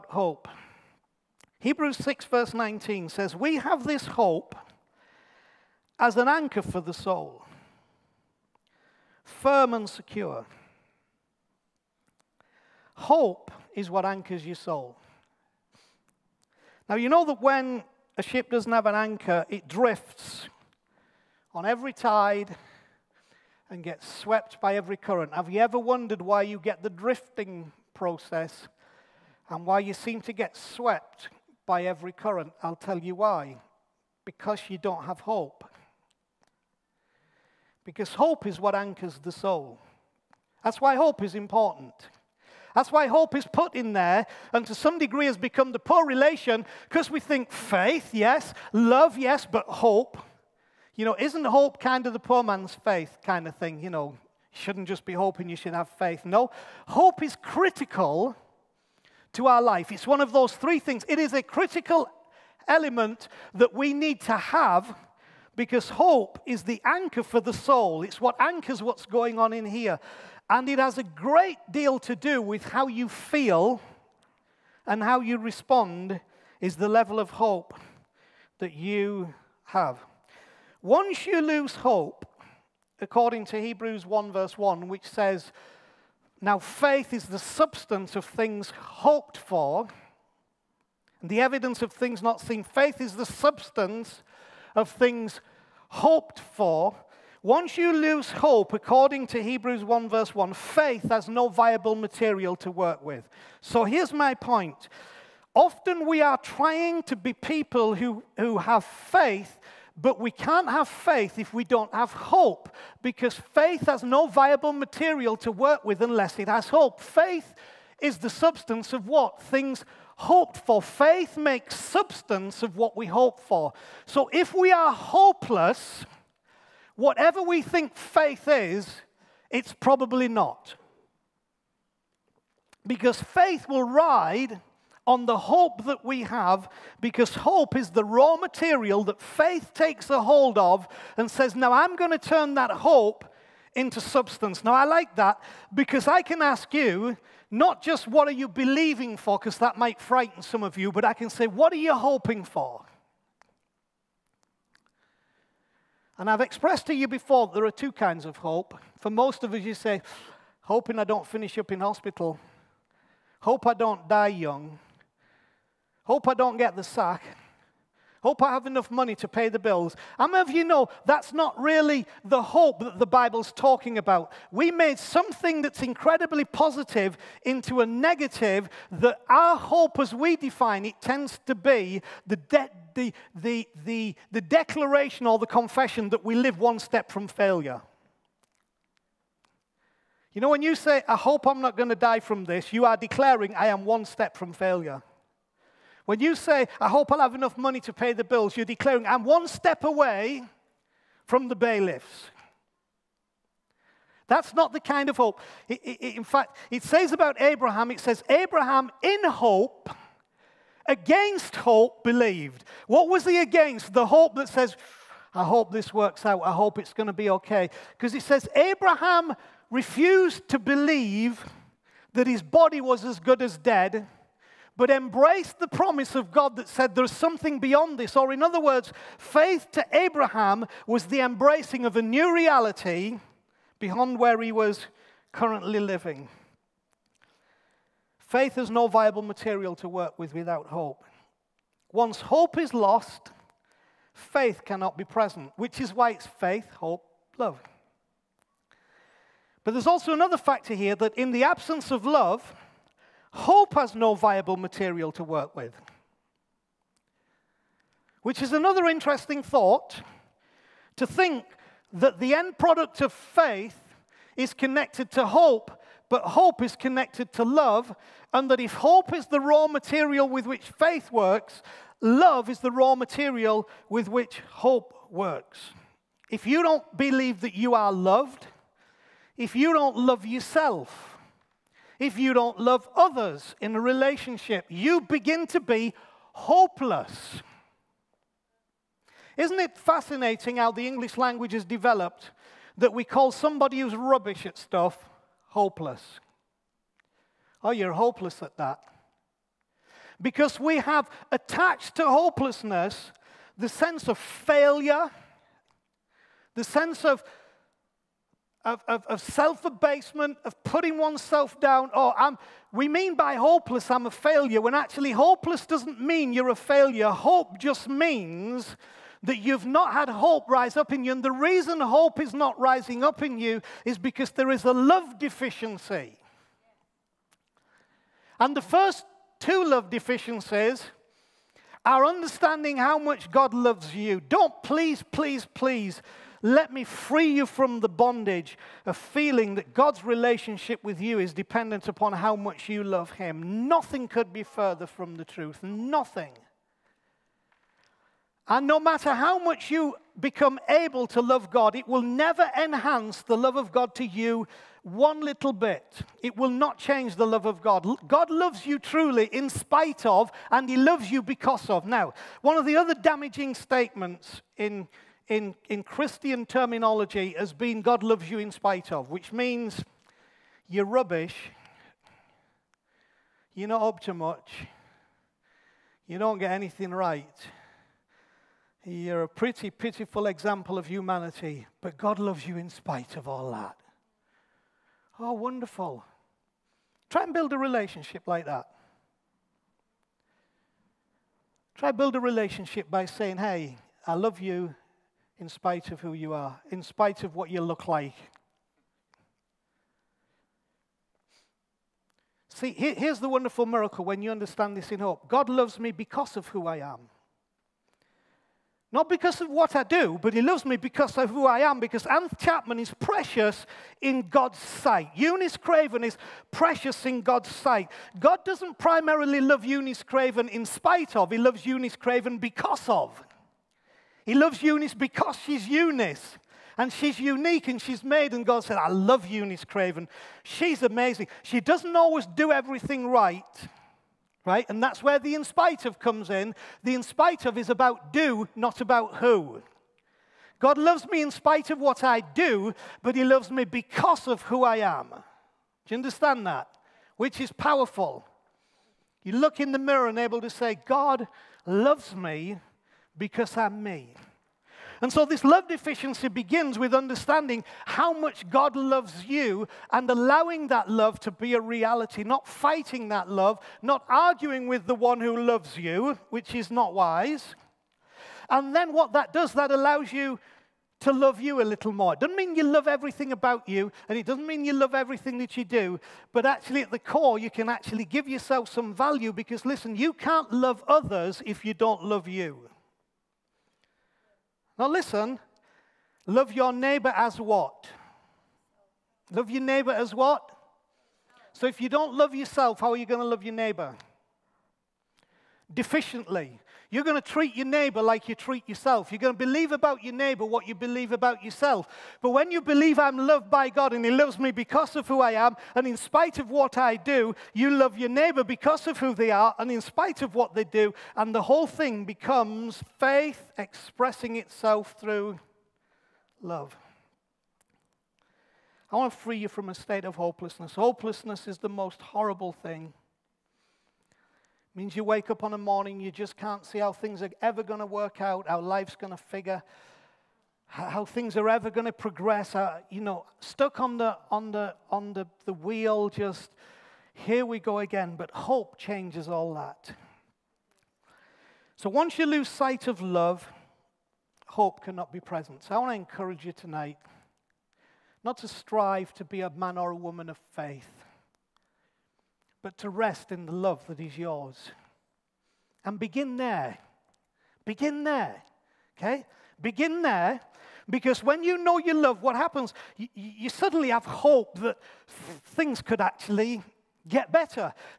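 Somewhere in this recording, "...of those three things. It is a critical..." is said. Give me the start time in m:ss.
1:00.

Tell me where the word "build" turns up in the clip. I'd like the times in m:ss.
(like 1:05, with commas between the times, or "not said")
6:27, 6:31.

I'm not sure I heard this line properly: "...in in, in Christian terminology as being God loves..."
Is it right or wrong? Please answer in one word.
right.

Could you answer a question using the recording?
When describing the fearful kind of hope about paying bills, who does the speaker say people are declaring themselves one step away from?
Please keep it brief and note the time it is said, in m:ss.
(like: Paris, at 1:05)
the bailiffs, at 3:21.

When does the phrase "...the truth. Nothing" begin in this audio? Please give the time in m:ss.
5:45.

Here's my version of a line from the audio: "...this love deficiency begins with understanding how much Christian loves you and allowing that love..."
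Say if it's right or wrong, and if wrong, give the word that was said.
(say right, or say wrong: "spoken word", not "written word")
wrong: "God", not "Christian".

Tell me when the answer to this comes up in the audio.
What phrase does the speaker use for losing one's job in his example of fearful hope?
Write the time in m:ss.
2:46.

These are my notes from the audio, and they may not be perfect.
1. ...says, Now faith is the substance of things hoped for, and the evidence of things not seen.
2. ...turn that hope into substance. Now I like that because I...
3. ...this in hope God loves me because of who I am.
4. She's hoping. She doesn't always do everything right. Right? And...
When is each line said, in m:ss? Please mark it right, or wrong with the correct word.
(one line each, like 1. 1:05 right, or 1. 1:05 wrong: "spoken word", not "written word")
1. 1:25 right
2. 2:22 right
3. 6:44 right
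4. 7:10 wrong: "amazing", not "hoping".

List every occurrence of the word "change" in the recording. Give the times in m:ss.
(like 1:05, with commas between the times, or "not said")
5:56, 8:58.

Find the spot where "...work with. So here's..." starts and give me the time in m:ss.
1:42.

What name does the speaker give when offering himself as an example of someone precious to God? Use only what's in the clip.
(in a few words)
Anth Chapman.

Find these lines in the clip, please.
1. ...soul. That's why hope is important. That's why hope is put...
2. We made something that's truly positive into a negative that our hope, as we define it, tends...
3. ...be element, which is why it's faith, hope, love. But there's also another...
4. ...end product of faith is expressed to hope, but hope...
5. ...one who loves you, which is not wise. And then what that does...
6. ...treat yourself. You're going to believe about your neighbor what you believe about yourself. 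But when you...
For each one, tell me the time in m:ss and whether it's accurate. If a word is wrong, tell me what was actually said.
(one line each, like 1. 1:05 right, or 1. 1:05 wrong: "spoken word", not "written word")
1. 0:39 right
2. 2:54 wrong: "incredibly", not "truly"
3. 4:04 wrong: "present", not "element"
4. 4:22 wrong: "connected", not "expressed"
5. 7:44 right
6. 8:18 right.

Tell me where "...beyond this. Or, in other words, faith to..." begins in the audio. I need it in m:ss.
3:47.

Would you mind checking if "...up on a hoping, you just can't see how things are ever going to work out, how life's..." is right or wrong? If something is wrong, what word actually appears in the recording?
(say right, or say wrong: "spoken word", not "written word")
wrong: "morning", not "hoping".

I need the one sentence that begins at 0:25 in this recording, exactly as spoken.
Have you ever wondered why you get the drifting process and why you seem to get swept by every current?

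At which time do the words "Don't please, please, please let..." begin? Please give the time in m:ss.
5:34.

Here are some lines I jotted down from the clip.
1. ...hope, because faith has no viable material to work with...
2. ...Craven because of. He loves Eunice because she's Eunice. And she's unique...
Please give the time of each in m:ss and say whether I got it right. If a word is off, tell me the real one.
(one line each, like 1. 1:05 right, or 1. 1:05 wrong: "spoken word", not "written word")
1. 1:52 right
2. 7:01 right.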